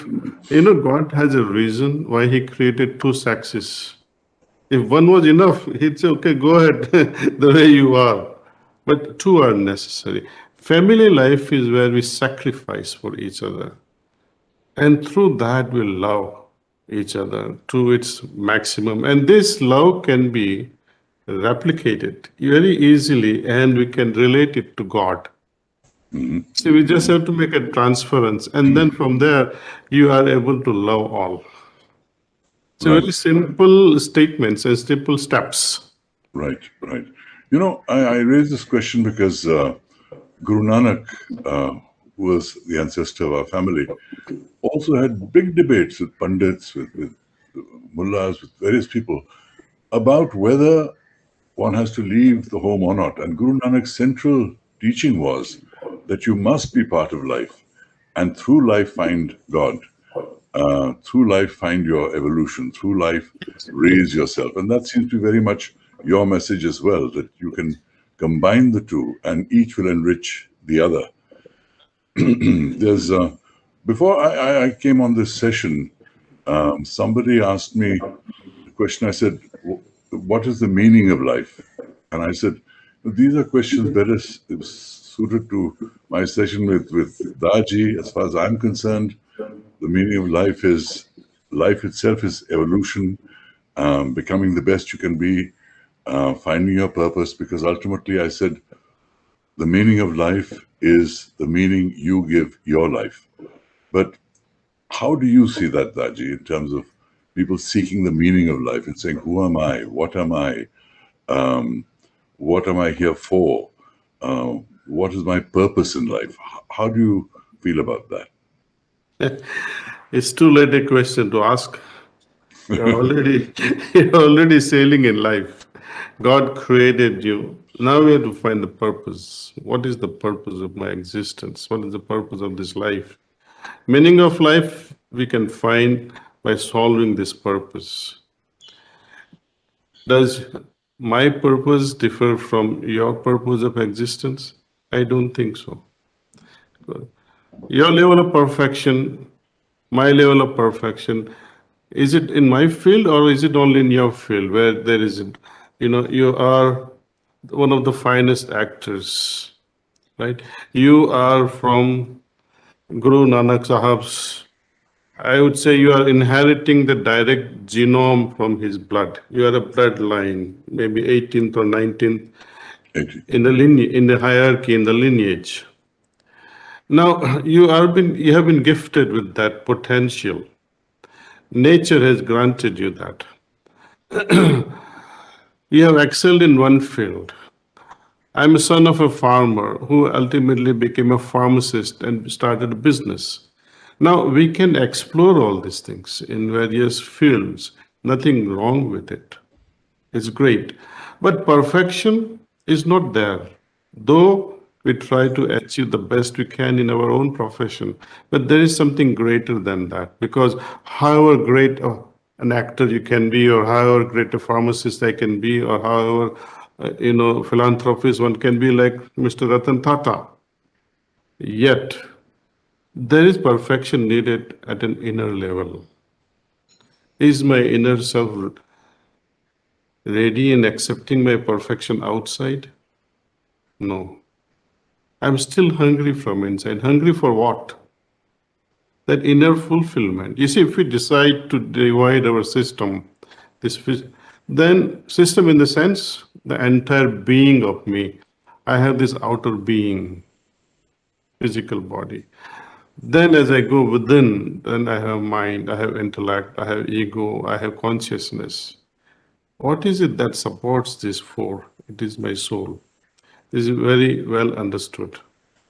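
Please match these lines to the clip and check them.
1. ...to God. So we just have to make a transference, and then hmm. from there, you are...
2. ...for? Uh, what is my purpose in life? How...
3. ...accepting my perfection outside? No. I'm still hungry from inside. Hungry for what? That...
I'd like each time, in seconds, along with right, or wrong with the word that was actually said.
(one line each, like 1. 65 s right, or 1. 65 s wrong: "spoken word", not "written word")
1. 24 s right
2. 113 s right
3. 230 s right.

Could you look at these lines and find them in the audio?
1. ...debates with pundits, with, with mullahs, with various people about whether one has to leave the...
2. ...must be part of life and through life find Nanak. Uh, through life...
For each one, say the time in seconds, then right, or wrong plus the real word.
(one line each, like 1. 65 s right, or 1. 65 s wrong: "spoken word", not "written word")
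1. 45 s right
2. 56 s wrong: "God", not "Nanak".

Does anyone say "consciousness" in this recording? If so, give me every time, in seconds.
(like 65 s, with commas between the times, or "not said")
257 s.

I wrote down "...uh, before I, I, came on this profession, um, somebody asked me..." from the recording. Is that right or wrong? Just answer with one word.
wrong.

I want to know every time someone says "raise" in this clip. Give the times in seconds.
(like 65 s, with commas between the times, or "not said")
38 s, 63 s.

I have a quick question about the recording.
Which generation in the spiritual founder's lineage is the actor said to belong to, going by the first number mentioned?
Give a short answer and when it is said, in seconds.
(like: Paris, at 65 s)
18th, at 171 s.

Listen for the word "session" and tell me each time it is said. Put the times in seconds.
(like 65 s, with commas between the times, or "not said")
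75 s, 86 s.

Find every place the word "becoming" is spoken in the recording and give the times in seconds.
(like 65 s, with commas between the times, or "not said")
94 s.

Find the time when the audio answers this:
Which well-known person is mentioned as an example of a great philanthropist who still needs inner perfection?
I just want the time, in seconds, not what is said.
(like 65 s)
219 s.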